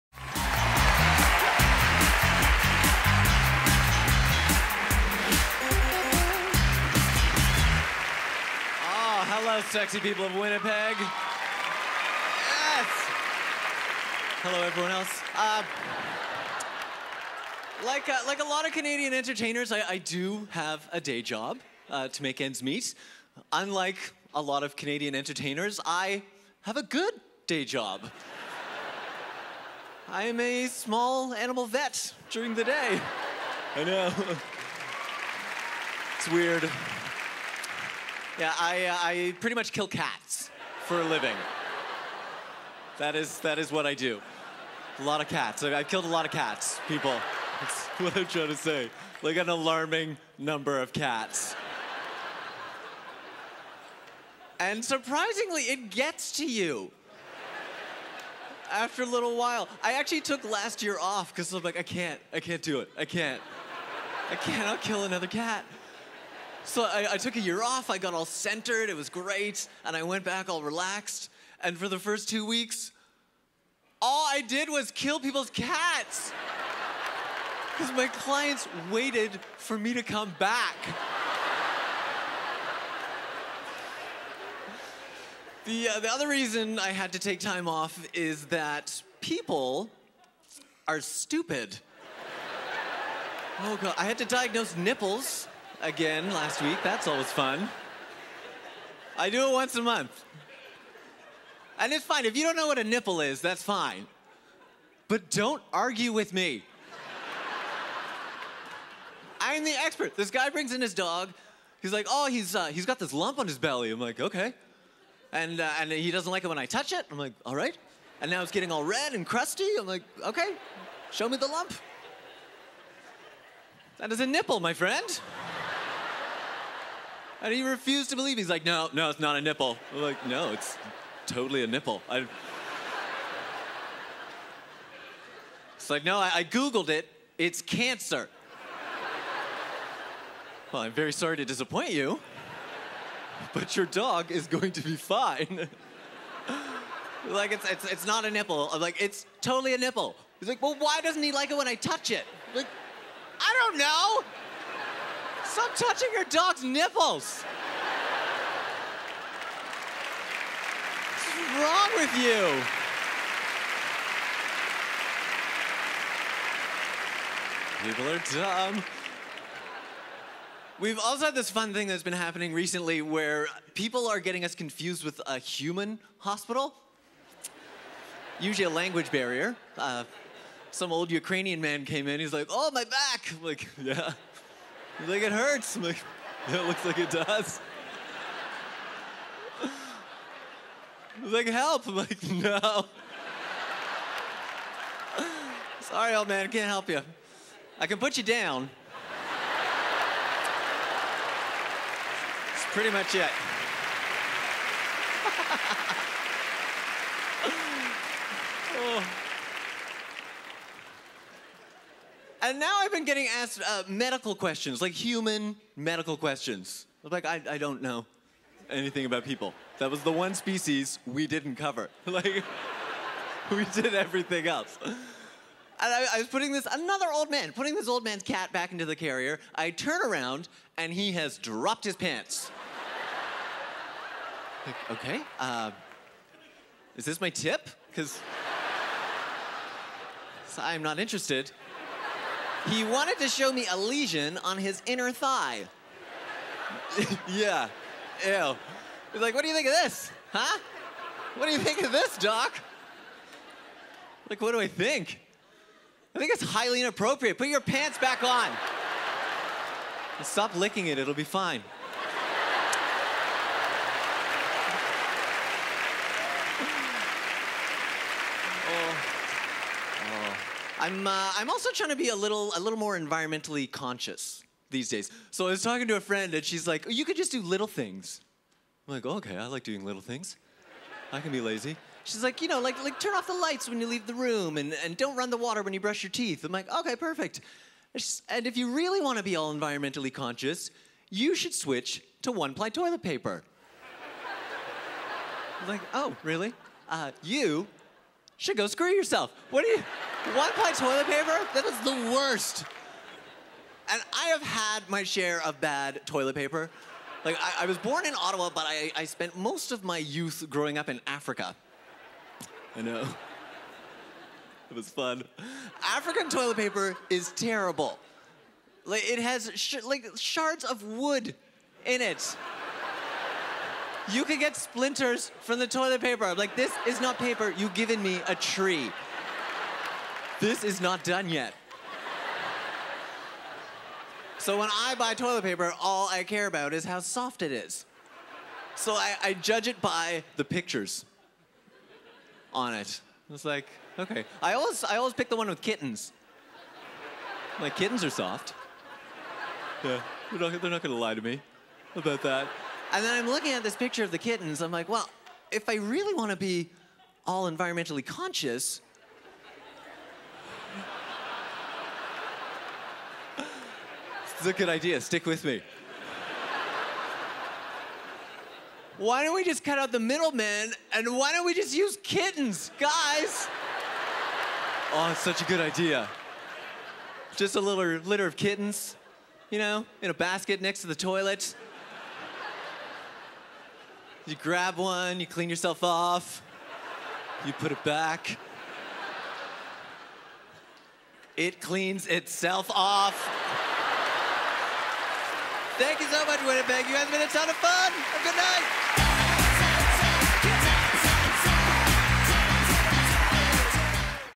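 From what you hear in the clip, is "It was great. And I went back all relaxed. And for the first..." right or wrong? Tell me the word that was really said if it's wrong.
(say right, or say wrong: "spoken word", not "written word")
right.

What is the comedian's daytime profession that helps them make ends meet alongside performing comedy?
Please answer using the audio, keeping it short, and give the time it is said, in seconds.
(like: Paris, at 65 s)
small animal vet, at 30 s.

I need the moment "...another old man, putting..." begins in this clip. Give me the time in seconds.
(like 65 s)
226 s.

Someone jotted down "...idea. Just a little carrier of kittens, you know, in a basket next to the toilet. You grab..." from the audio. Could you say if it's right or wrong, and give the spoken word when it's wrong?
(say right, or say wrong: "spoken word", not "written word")
wrong: "litter", not "carrier".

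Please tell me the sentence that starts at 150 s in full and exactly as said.
He's like, well, why doesn't he like it when I touch it?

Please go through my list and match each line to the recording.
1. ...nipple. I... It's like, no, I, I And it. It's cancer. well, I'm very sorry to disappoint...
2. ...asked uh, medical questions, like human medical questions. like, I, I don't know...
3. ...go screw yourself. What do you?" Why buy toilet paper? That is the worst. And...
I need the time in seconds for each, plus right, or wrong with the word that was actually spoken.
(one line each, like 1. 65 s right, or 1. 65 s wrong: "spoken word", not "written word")
1. 131 s wrong: "Googled", not "And"
2. 213 s right
3. 298 s right.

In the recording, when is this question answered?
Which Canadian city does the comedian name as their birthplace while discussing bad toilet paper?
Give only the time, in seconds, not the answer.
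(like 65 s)
308 s.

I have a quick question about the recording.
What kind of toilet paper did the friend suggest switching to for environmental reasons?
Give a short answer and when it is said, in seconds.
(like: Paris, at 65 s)
one-ply, at 292 s.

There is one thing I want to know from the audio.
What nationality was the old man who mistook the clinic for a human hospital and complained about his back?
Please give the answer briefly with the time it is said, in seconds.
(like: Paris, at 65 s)
Ukrainian, at 181 s.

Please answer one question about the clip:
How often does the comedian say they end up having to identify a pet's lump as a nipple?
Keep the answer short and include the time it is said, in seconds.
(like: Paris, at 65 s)
once a month, at 99 s.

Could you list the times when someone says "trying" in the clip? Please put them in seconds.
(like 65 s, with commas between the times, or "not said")
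48 s, 271 s.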